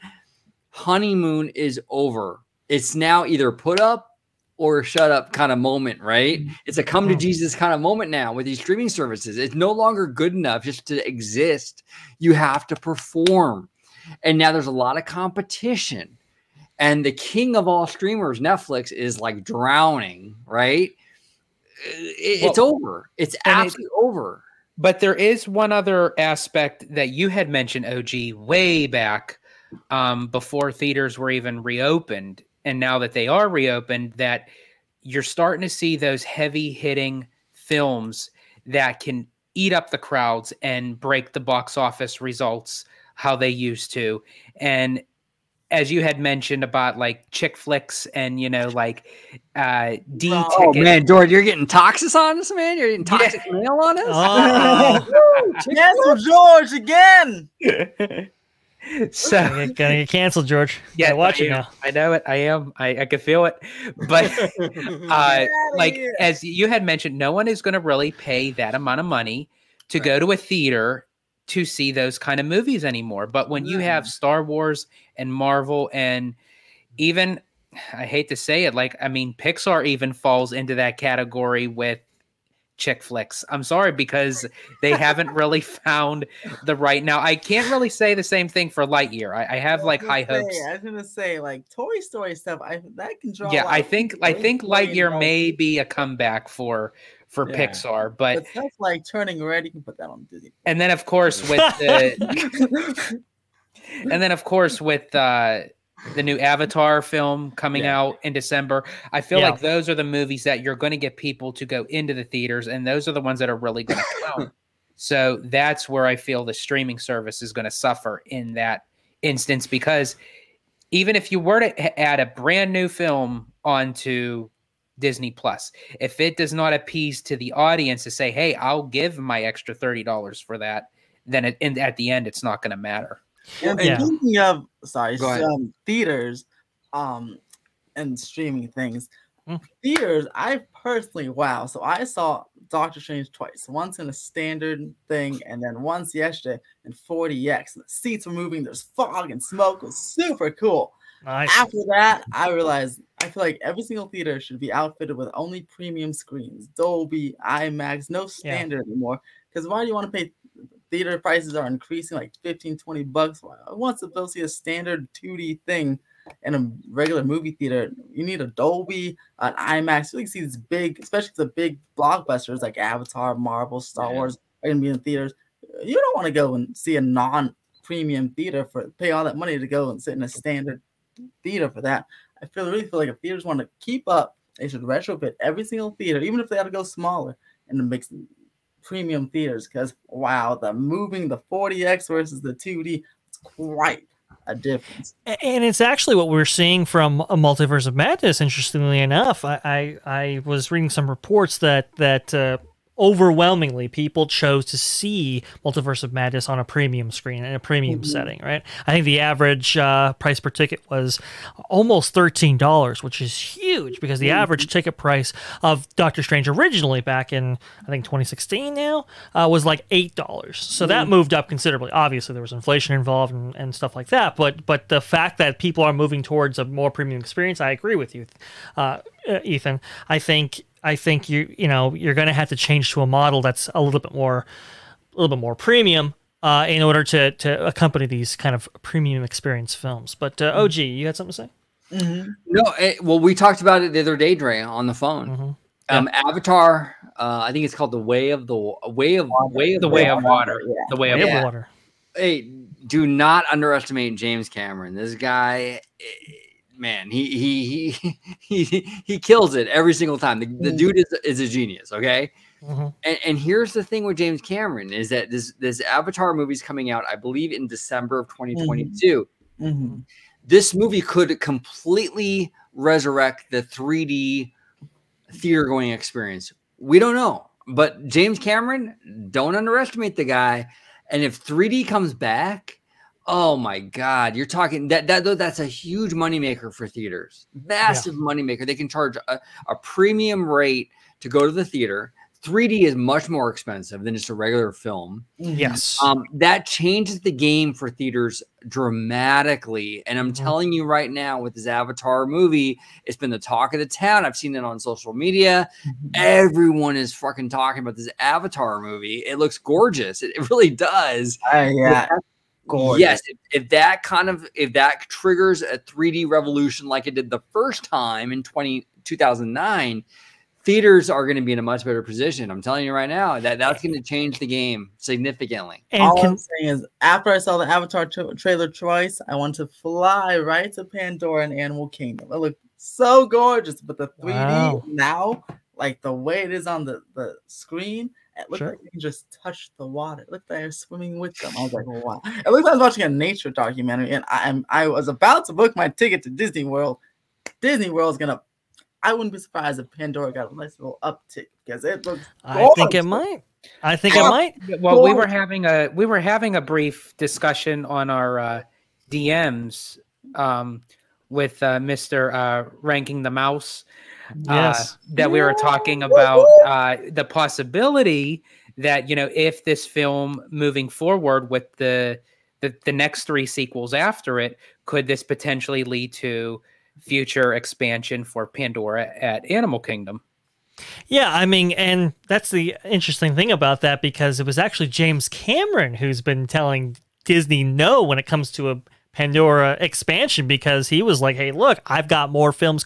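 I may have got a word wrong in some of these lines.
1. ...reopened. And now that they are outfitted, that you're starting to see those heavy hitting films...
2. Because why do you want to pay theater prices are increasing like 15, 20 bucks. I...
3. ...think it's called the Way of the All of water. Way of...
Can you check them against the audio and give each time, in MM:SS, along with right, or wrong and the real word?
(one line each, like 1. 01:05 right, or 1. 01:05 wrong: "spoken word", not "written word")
1. 00:31 wrong: "reopened", not "outfitted"
2. 02:39 right
3. 04:07 wrong: "Way", not "All".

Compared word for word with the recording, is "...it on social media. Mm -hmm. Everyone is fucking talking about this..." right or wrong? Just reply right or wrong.
right.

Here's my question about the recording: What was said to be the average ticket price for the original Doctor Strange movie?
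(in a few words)
$8.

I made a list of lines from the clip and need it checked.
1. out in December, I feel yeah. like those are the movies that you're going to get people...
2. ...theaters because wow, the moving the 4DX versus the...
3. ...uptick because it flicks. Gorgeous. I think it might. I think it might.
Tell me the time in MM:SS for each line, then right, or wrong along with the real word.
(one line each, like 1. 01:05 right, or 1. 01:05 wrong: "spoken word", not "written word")
1. 01:47 right
2. 03:09 right
3. 05:51 wrong: "looks", not "flicks".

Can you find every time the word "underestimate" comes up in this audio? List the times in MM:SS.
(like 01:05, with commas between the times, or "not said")
04:13, 04:39.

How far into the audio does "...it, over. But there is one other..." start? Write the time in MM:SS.
00:23.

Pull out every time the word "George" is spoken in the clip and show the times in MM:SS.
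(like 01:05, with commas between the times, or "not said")
00:51, 00:56, 01:00.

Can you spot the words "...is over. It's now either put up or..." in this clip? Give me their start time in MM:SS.
00:01.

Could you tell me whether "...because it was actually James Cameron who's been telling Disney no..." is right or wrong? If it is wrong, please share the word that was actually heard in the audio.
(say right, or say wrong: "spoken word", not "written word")
right.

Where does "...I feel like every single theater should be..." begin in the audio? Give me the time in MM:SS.
02:33.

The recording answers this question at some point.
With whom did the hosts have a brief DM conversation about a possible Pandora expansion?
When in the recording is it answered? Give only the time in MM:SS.
06:02.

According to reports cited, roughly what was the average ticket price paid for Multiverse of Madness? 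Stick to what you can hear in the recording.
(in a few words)
almost $13.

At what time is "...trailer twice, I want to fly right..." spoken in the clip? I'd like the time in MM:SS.
05:28.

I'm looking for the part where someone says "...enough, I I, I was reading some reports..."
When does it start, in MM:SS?
03:19.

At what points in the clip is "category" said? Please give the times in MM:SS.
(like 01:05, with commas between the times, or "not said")
01:20.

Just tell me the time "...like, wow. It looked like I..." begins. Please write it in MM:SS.
05:41.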